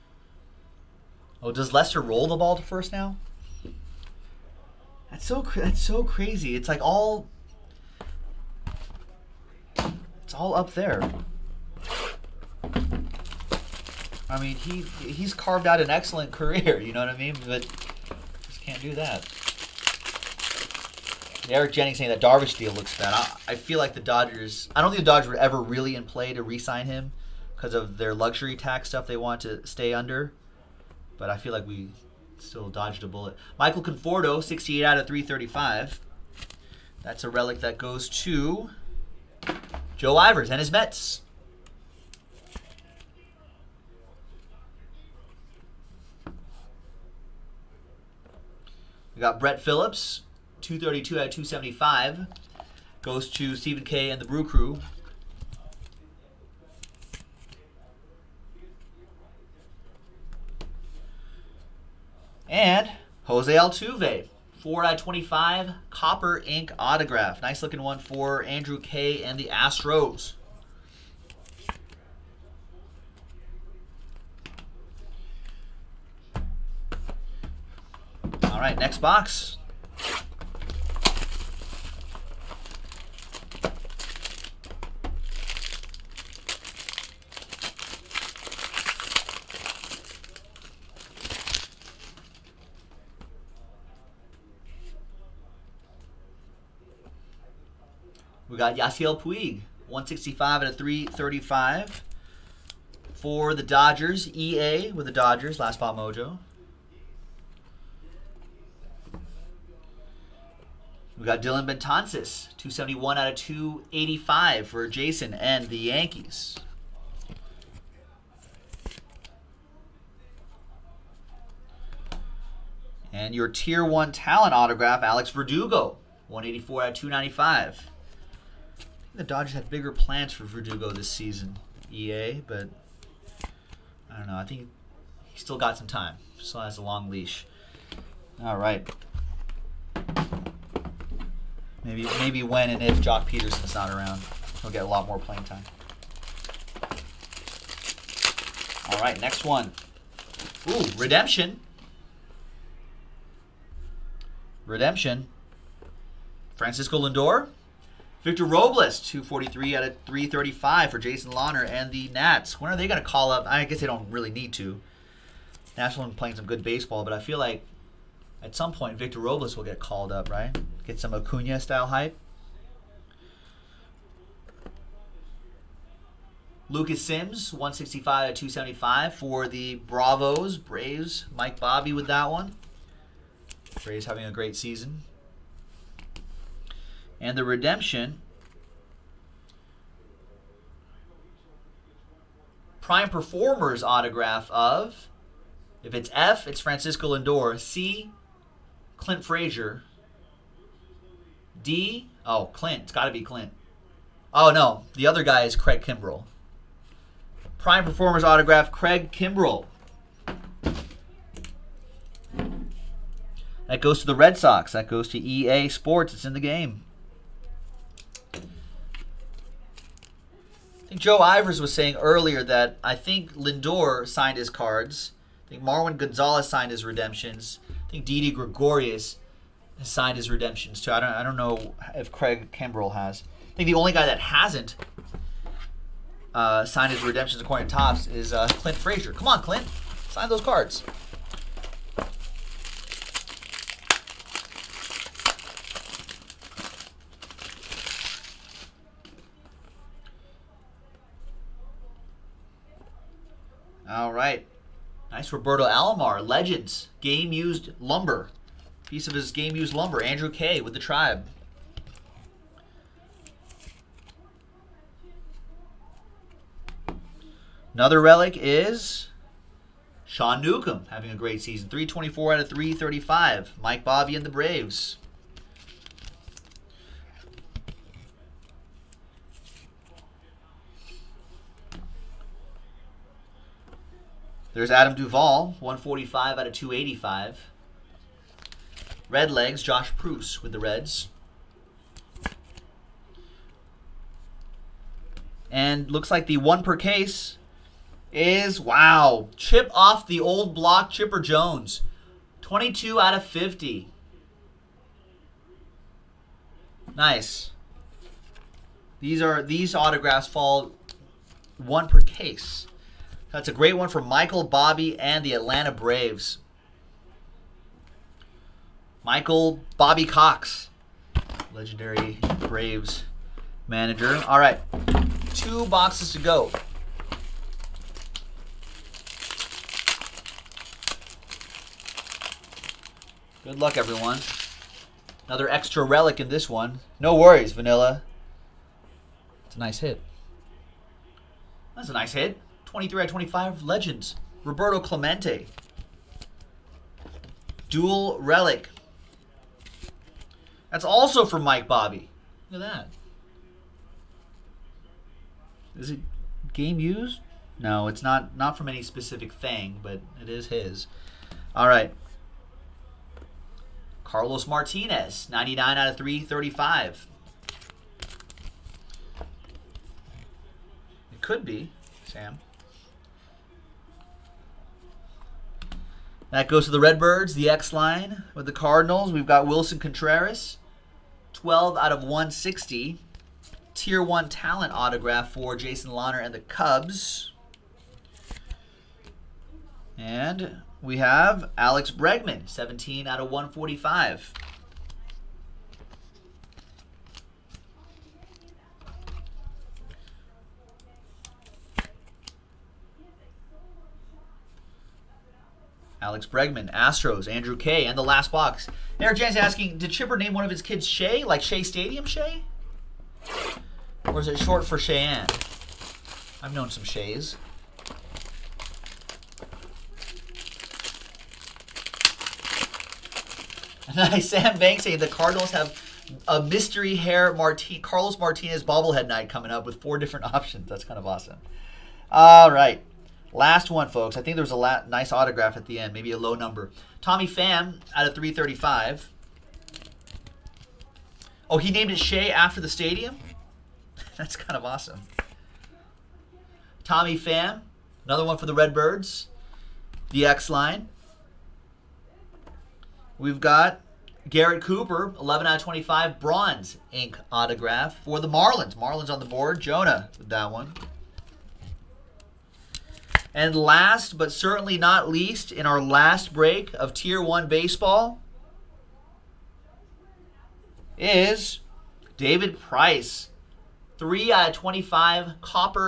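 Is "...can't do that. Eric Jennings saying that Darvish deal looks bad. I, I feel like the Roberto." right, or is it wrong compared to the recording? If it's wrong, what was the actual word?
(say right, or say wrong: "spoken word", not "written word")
wrong: "Dodgers", not "Roberto".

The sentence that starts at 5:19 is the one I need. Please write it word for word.
Michael Bobby Cox, legendary Braves manager.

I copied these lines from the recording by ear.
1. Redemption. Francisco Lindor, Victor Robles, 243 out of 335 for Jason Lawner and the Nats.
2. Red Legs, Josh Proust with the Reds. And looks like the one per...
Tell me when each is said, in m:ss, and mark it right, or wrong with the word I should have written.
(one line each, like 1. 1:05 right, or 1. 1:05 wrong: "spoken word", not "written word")
1. 2:34 right
2. 4:49 right.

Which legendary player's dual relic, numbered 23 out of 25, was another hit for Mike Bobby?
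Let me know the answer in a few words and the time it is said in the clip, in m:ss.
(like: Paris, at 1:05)
Roberto Clemente, at 5:44.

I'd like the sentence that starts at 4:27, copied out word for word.
Another relic is Sean Newcomb having a great season.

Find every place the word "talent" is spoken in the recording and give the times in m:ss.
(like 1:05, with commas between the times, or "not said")
2:04, 6:24.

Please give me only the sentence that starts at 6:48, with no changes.
Eric Jans asking, did Chipper name one of his kids Shay, like Shea Stadium Shay?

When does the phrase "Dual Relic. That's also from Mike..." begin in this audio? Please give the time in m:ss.
5:47.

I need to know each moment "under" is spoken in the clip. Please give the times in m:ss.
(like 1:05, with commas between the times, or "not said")
0:29.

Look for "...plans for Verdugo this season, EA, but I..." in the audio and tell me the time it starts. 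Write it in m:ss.
2:09.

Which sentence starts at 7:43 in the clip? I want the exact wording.
And last but certainly not least, in our last break of Tier 1 baseball, is David Price.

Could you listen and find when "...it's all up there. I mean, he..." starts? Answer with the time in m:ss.
0:10.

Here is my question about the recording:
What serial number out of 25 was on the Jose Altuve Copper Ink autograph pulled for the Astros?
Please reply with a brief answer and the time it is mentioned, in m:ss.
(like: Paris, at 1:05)
4, at 1:04.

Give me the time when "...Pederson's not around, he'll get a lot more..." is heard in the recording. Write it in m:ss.
2:23.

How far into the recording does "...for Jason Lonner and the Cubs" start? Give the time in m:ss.
6:25.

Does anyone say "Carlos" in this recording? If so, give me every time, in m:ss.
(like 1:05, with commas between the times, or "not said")
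6:04, 7:07.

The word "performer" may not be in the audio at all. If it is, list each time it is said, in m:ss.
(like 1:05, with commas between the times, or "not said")
3:13, 3:27.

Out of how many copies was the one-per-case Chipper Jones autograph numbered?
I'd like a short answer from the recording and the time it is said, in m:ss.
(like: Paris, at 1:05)
50, at 5:02.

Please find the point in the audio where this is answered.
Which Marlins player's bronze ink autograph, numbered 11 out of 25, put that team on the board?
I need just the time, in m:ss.
7:34.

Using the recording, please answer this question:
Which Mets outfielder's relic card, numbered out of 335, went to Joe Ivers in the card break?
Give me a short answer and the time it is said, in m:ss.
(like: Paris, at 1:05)
Michael Conforto, at 0:33.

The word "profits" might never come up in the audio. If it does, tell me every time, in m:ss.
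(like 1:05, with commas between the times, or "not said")
not said.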